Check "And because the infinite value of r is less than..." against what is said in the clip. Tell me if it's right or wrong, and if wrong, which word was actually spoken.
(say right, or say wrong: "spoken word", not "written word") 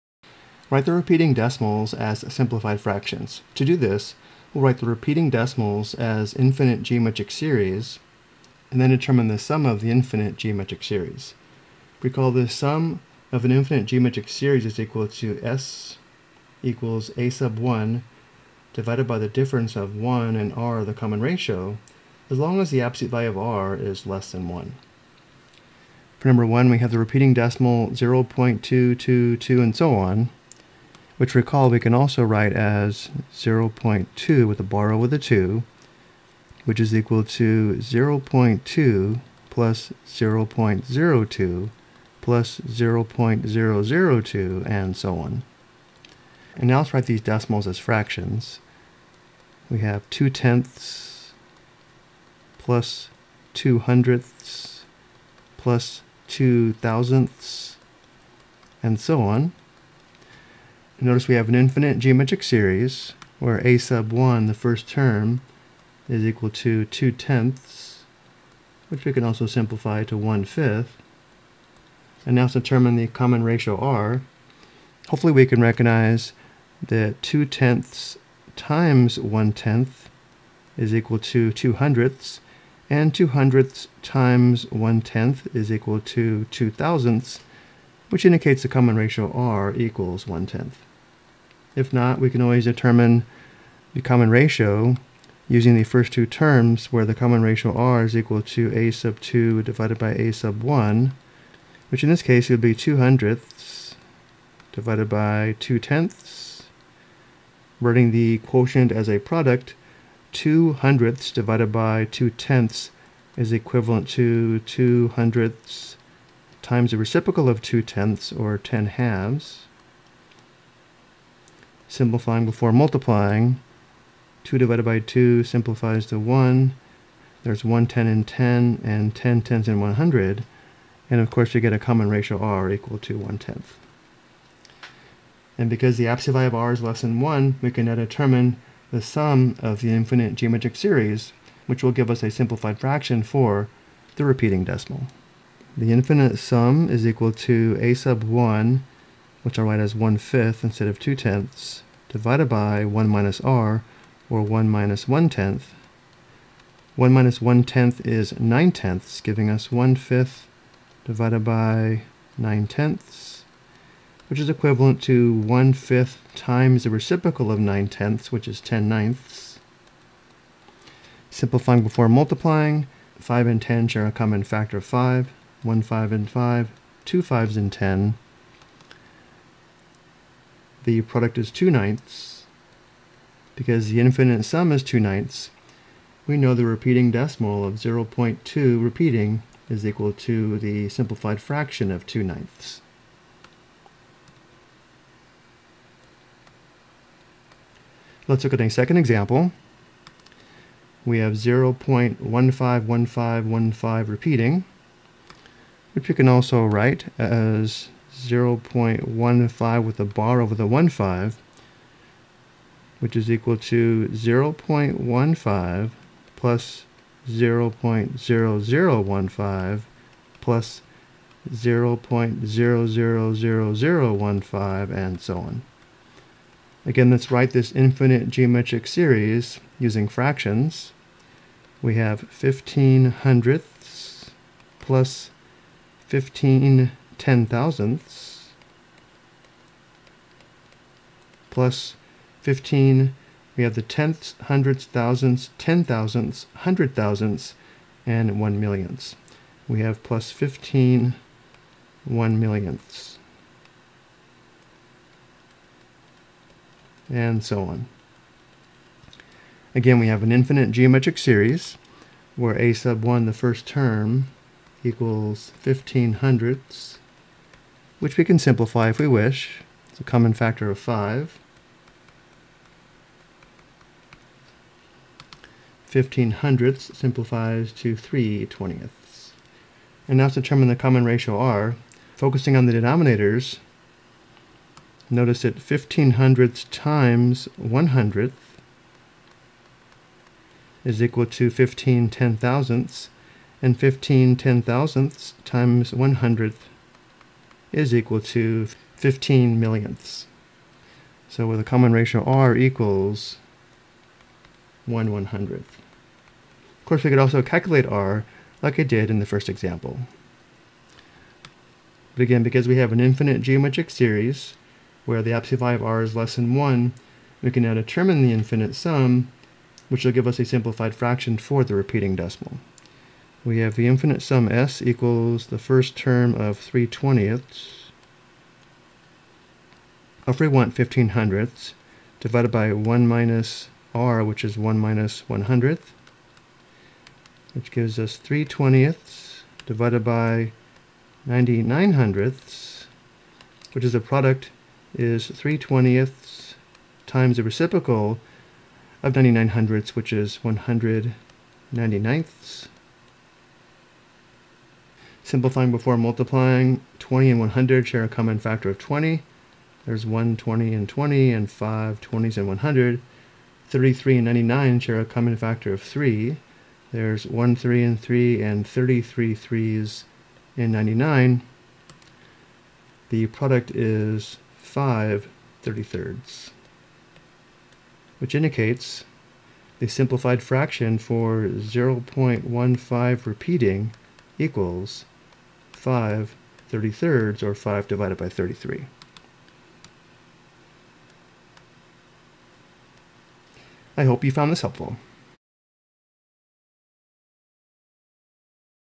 wrong: "absolute", not "infinite".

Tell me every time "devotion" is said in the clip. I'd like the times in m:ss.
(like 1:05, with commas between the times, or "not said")
not said.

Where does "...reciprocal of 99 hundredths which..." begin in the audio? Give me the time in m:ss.
5:47.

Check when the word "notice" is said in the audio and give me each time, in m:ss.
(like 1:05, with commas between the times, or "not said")
1:01, 4:45.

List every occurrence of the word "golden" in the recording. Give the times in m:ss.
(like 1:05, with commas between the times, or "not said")
not said.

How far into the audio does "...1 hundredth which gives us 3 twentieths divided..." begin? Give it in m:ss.
5:35.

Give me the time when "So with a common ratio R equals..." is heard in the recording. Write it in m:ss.
5:01.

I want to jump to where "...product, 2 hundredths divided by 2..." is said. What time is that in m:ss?
1:49.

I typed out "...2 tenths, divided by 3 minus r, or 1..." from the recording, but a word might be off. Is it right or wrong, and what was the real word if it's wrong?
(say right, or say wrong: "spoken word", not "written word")
wrong: "1", not "3".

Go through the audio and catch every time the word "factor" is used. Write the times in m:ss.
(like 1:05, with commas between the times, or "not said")
2:54, 4:30, 5:58, 6:05.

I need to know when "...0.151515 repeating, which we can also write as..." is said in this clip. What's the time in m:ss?
3:21.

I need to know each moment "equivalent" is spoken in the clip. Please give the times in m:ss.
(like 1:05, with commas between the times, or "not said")
1:53, 2:44.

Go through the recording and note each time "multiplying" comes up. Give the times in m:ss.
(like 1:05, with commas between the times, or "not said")
2:02, 2:52, 5:55.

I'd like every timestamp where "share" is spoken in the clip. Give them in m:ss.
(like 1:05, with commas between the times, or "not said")
2:53, 5:57, 6:04.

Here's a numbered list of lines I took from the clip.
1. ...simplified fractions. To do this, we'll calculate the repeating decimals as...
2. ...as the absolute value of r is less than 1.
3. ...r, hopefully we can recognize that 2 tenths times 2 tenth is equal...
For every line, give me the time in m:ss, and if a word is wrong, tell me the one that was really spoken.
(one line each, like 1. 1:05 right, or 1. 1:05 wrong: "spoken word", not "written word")
1. 0:02 wrong: "write", not "calculate"
2. 0:22 right
3. 1:13 wrong: "1", not "2".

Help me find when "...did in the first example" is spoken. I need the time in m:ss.
5:08.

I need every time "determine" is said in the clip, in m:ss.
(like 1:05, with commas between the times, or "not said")
0:08, 1:12, 1:32, 2:17, 4:40, 5:17.